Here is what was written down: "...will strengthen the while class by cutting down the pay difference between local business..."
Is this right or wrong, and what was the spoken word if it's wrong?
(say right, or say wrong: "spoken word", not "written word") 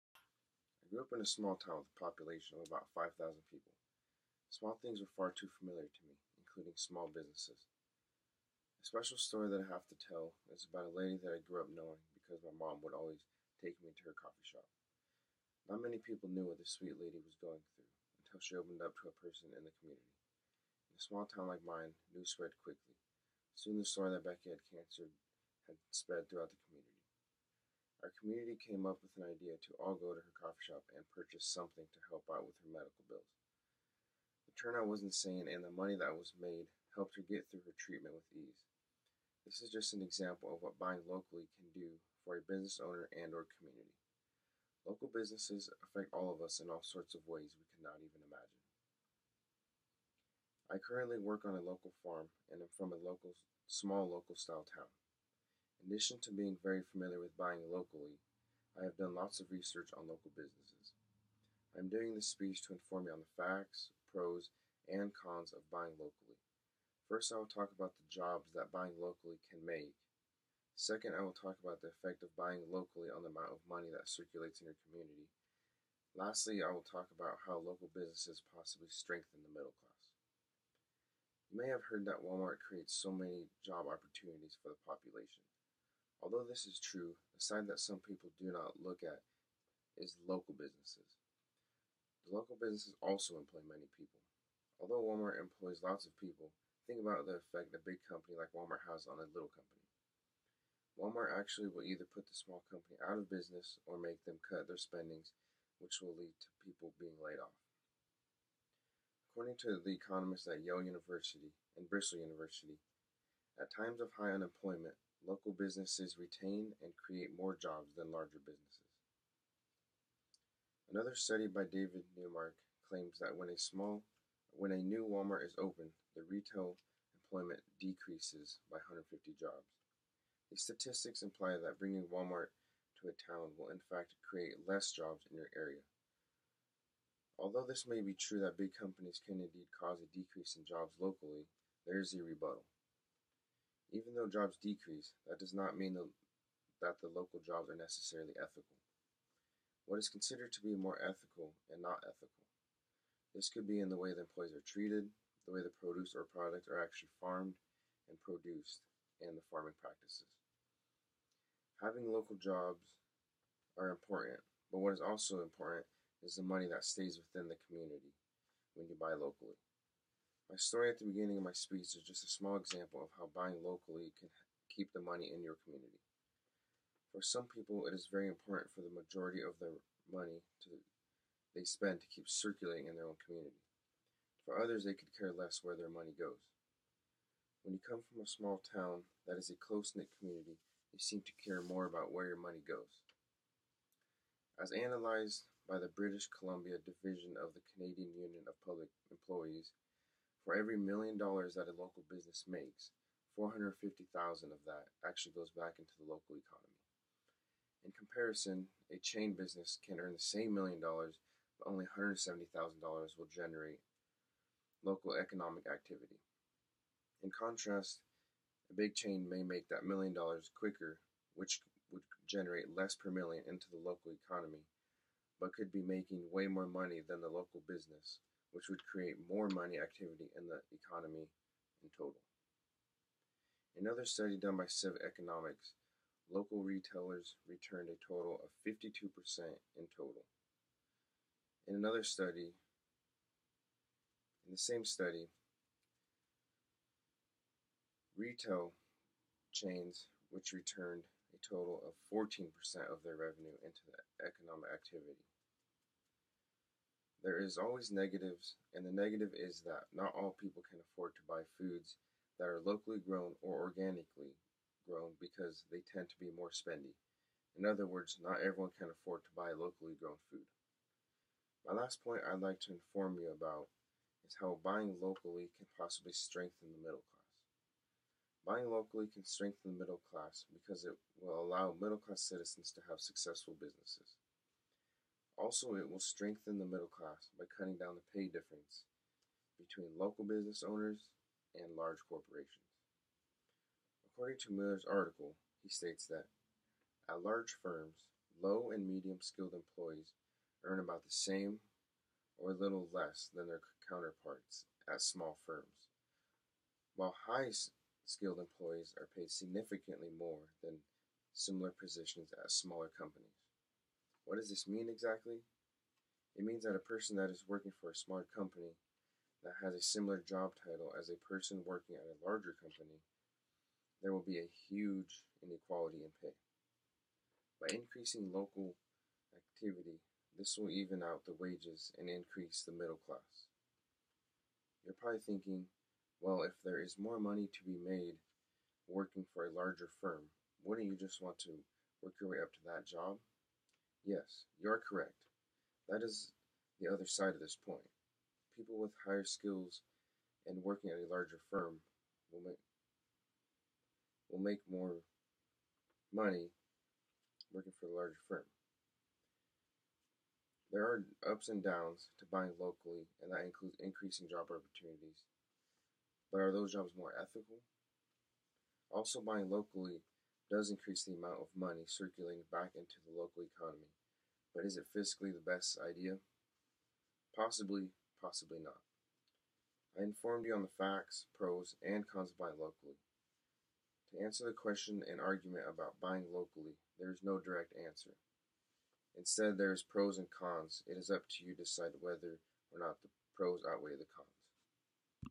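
wrong: "middle", not "while".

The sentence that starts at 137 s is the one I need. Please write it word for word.
Although this may be true that big companies can indeed cause a decrease in jobs locally, there is a rebuttal.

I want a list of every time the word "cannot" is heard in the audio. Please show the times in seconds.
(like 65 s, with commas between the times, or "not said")
47 s.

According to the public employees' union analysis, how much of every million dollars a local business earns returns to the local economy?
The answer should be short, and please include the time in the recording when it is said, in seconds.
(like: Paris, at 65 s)
$450,000, at 203 s.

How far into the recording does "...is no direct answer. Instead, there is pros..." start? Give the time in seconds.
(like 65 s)
387 s.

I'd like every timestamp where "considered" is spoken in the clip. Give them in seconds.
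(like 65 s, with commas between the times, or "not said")
150 s.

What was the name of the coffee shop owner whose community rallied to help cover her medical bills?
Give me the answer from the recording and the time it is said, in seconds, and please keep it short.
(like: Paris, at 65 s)
Becky, at 24 s.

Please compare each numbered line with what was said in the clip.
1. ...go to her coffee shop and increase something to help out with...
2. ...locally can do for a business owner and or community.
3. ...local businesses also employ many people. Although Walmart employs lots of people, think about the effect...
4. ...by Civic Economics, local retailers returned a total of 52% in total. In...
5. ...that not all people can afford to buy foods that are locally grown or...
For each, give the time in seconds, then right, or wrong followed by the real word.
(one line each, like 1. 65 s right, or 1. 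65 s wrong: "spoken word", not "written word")
1. 29 s wrong: "purchase", not "increase"
2. 41 s right
3. 92 s right
4. 234 s right
5. 259 s right.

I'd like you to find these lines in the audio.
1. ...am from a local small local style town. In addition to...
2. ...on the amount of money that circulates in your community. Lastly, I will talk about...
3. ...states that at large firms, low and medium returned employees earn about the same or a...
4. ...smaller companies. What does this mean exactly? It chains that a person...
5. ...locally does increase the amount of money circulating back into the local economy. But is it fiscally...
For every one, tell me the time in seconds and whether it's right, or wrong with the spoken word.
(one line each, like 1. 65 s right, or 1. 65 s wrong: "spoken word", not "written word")
1. 52 s right
2. 73 s right
3. 295 s wrong: "skilled", not "returned"
4. 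312 s wrong: "means", not "chains"
5. 369 s right.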